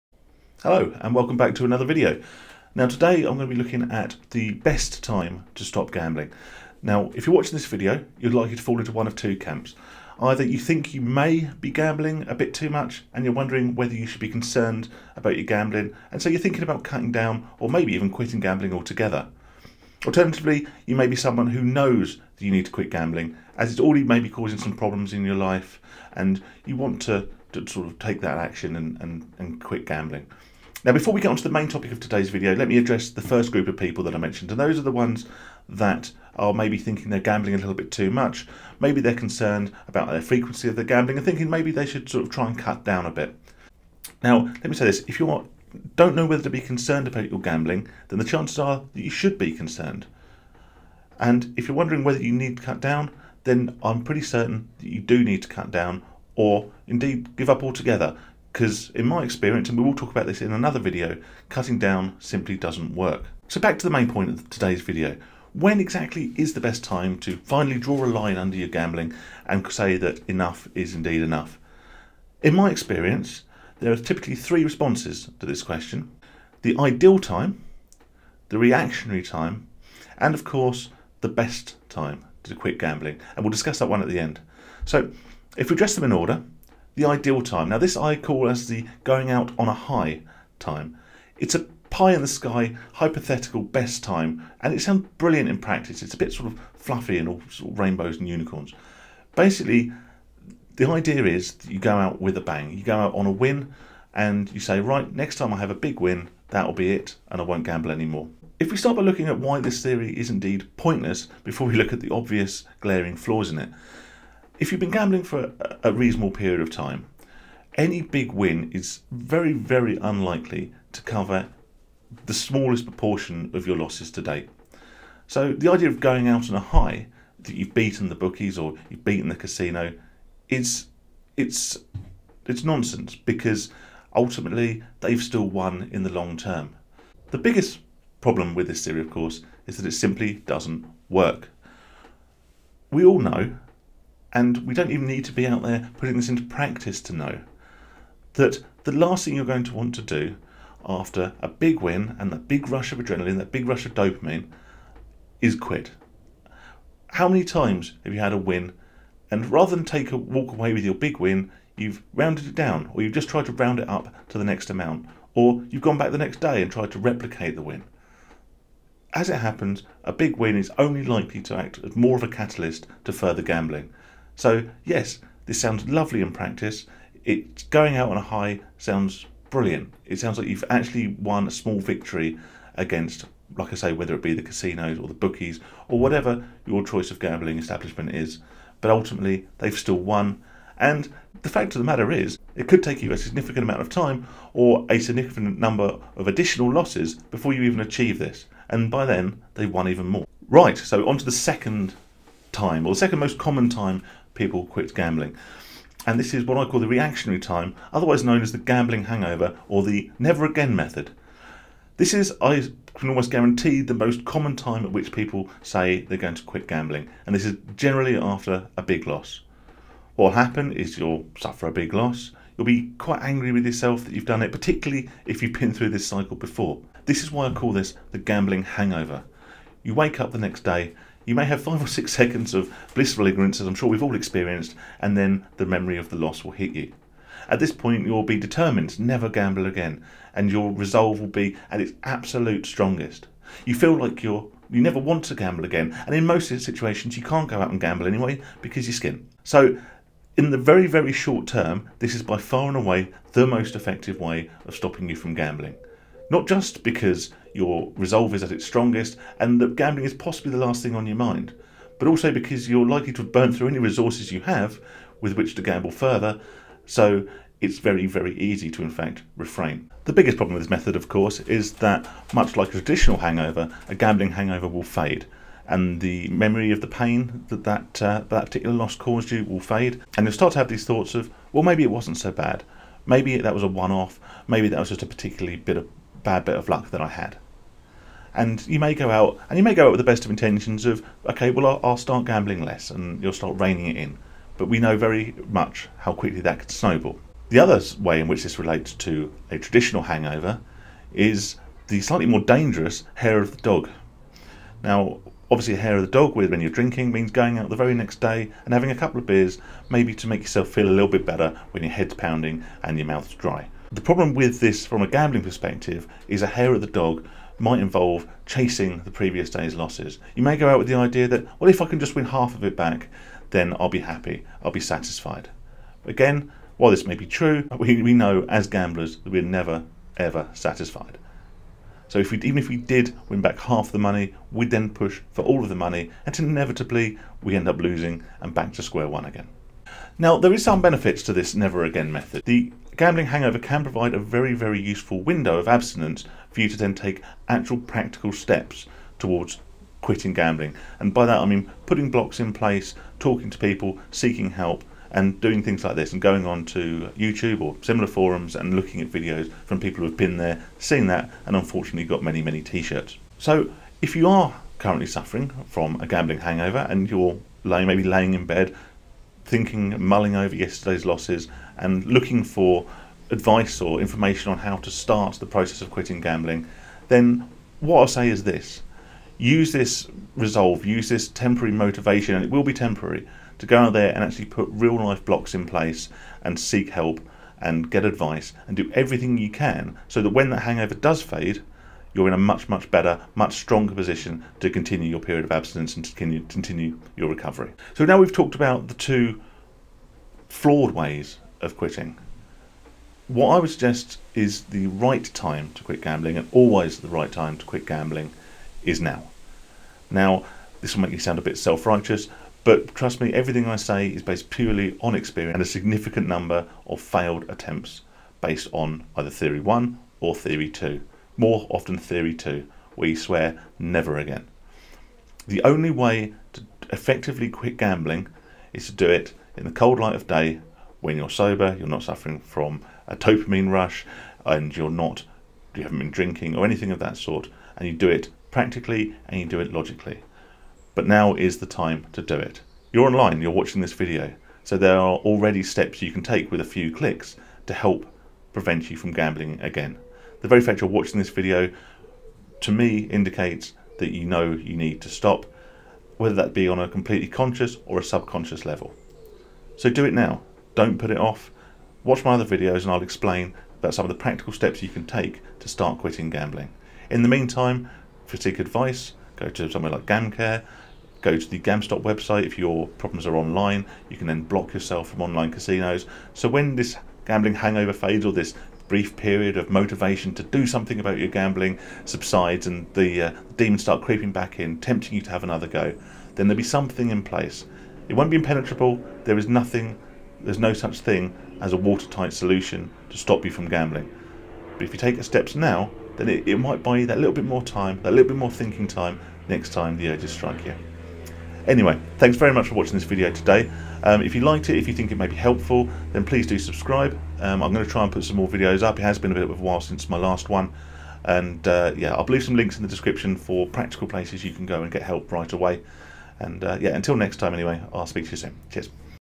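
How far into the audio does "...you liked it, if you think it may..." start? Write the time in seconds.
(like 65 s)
504 s.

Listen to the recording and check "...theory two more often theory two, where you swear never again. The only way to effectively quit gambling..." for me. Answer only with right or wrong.
right.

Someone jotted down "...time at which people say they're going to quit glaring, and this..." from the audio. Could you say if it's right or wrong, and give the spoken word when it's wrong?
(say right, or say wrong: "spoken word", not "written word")
wrong: "gambling", not "glaring".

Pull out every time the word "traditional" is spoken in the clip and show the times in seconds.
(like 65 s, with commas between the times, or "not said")
272 s, 299 s.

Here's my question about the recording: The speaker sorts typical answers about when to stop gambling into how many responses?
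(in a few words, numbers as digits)
3.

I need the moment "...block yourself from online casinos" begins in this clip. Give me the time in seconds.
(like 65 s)
474 s.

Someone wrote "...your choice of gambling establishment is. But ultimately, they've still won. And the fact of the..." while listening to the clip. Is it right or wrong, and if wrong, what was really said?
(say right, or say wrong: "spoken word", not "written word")
right.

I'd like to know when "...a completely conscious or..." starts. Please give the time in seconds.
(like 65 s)
456 s.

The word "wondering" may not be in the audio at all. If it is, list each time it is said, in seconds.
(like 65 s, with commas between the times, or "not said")
13 s, 51 s.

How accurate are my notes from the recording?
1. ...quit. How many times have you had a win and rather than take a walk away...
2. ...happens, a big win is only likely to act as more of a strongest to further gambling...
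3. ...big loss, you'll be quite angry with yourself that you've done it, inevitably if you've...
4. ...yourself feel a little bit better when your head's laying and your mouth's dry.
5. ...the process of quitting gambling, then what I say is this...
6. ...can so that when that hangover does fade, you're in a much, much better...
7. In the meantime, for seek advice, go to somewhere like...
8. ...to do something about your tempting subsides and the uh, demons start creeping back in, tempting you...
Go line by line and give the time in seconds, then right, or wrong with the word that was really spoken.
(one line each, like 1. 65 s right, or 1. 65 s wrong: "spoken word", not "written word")
1. 155 s right
2. 169 s wrong: "catalyst", not "strongest"
3. 221 s wrong: "particularly", not "inevitably"
4. 310 s wrong: "pounding", not "laying"
5. 375 s right
6. 389 s right
7. 467 s right
8. 480 s wrong: "gambling", not "tempting".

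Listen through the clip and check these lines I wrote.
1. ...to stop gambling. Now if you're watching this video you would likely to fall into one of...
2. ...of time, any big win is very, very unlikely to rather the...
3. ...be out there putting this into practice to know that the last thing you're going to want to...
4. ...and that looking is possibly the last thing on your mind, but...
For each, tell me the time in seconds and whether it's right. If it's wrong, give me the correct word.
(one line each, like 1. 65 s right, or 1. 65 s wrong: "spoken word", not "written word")
1. 5 s right
2. 116 s wrong: "cover", not "rather"
3. 145 s right
4. 259 s wrong: "gambling", not "looking".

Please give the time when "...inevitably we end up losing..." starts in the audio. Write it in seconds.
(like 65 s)
336 s.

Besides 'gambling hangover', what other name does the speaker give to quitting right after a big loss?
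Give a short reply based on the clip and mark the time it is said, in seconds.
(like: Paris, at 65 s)
The never again method, at 209 s.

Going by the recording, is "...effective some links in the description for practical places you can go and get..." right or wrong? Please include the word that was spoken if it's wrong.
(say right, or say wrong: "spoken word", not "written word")
wrong: "leave", not "effective".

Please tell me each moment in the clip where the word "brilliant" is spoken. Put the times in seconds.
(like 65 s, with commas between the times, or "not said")
95 s, 179 s.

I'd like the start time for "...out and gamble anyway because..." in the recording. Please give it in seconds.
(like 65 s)
247 s.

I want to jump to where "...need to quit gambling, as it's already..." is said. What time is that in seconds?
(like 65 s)
22 s.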